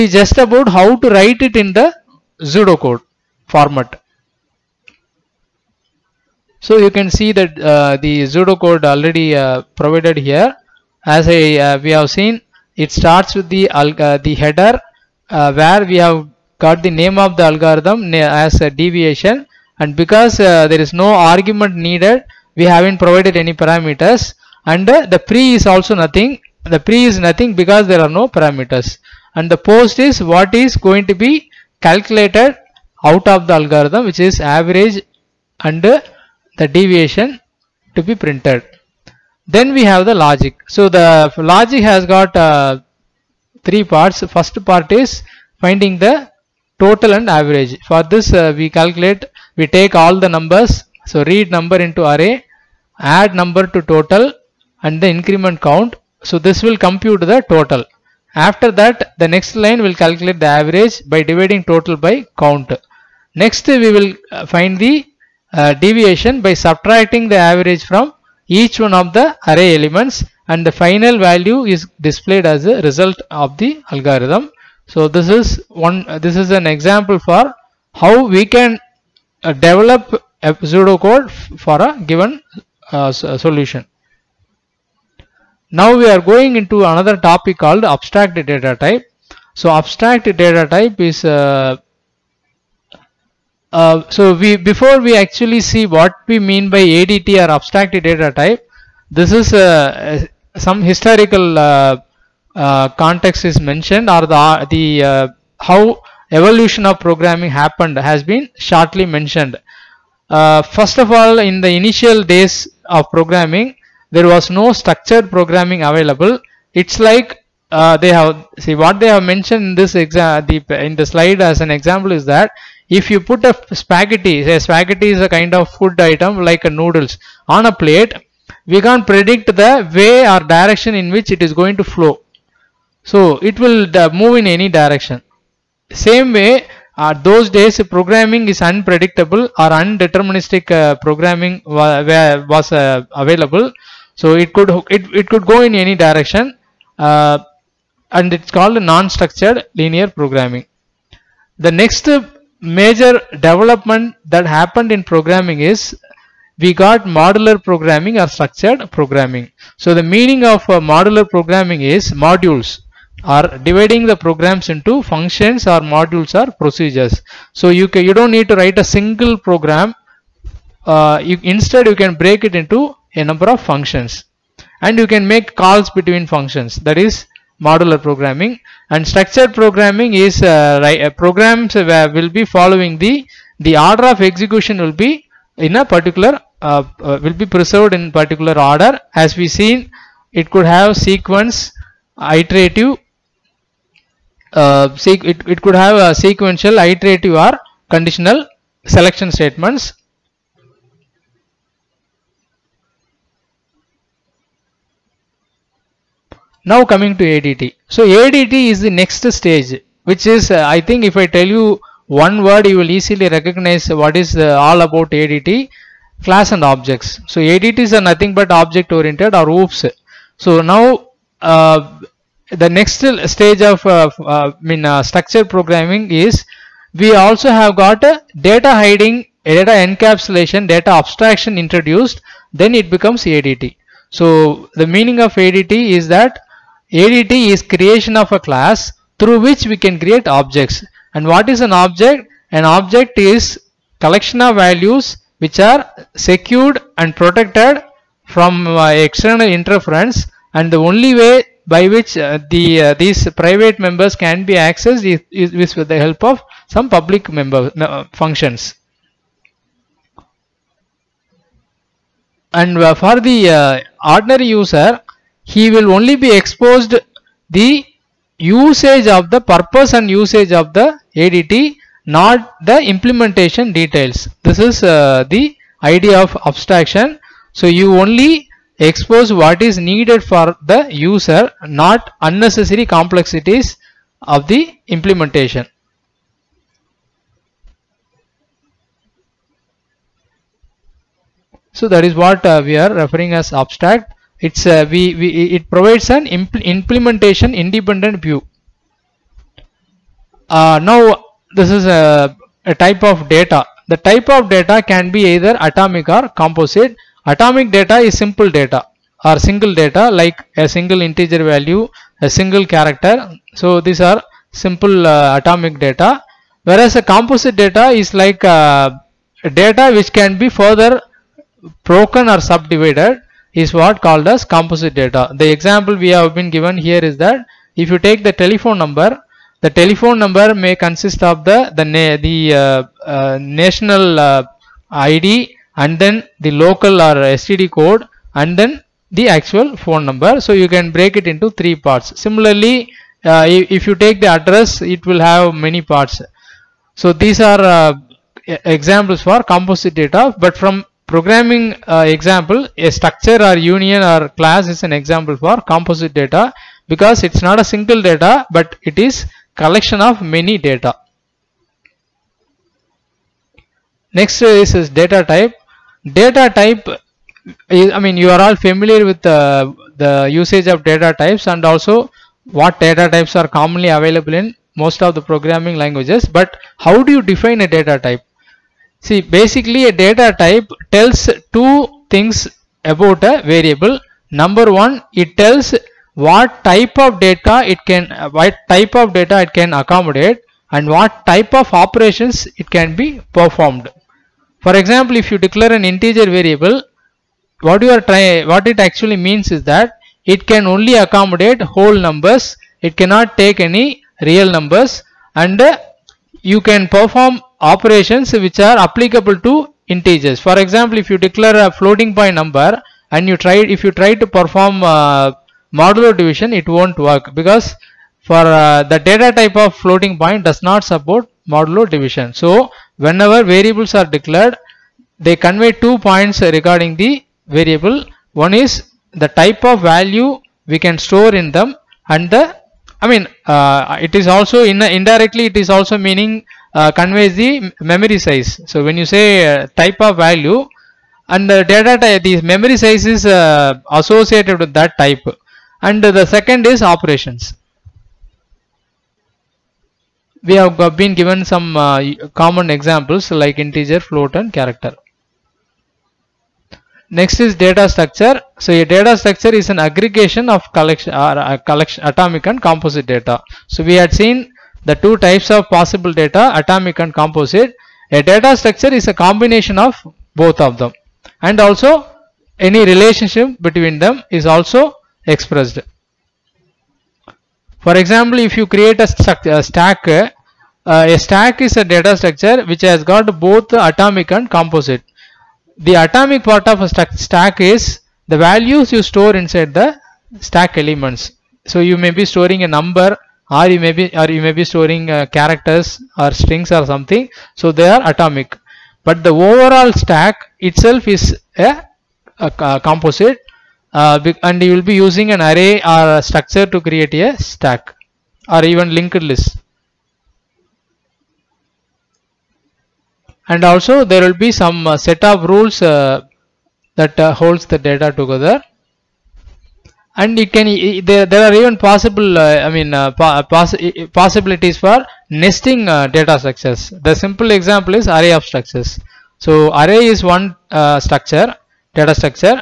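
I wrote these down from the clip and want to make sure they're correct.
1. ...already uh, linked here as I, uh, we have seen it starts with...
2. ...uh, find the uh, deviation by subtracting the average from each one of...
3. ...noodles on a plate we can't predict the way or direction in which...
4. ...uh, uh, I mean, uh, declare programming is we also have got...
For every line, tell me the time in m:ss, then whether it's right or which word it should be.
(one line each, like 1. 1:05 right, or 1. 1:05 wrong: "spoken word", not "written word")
1. 0:08 wrong: "provided", not "linked"
2. 1:04 right
3. 2:06 right
4. 3:43 wrong: "structure", not "declare".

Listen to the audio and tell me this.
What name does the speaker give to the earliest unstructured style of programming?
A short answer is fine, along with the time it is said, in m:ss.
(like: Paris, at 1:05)
non-structured linear programming, at 2:28.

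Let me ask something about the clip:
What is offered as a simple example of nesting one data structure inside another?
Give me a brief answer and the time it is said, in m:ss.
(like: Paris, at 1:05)
array of structures, at 8:48.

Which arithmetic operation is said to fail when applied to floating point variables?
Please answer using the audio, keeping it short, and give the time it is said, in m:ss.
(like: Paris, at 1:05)
modulo division, at 7:01.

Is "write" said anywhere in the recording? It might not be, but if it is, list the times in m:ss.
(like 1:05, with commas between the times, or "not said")
0:01, 2:48.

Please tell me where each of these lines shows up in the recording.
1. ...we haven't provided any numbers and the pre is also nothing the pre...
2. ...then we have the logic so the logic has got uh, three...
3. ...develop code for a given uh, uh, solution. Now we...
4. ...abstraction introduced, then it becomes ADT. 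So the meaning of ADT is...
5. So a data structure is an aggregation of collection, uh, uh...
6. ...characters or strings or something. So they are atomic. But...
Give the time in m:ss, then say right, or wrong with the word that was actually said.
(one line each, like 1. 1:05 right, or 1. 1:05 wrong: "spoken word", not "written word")
1. 0:22 wrong: "parameters", not "numbers"
2. 0:39 right
3. 1:19 right
4. 3:50 right
5. 7:38 right
6. 8:15 right.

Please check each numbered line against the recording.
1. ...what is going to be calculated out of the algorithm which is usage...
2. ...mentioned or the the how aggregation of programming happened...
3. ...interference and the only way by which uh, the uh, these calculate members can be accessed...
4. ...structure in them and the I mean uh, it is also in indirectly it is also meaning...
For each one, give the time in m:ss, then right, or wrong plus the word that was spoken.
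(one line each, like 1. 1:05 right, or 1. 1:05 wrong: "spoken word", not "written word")
1. 0:30 wrong: "average", not "usage"
2. 1:43 wrong: "evolution", not "aggregation"
3. 4:09 wrong: "private", not "calculate"
4. 7:10 wrong: "store", not "structure".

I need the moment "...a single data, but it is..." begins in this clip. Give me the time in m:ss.
5:57.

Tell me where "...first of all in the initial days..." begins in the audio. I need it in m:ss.
1:50.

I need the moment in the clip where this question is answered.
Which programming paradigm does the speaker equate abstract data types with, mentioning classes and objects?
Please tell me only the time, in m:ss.
3:39.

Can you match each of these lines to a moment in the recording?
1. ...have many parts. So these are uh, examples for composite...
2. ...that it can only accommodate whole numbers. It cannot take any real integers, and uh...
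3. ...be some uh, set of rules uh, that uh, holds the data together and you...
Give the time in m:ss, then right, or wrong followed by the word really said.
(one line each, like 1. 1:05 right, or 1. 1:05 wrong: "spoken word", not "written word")
1. 5:45 right
2. 6:39 wrong: "numbers", not "integers"
3. 8:34 right.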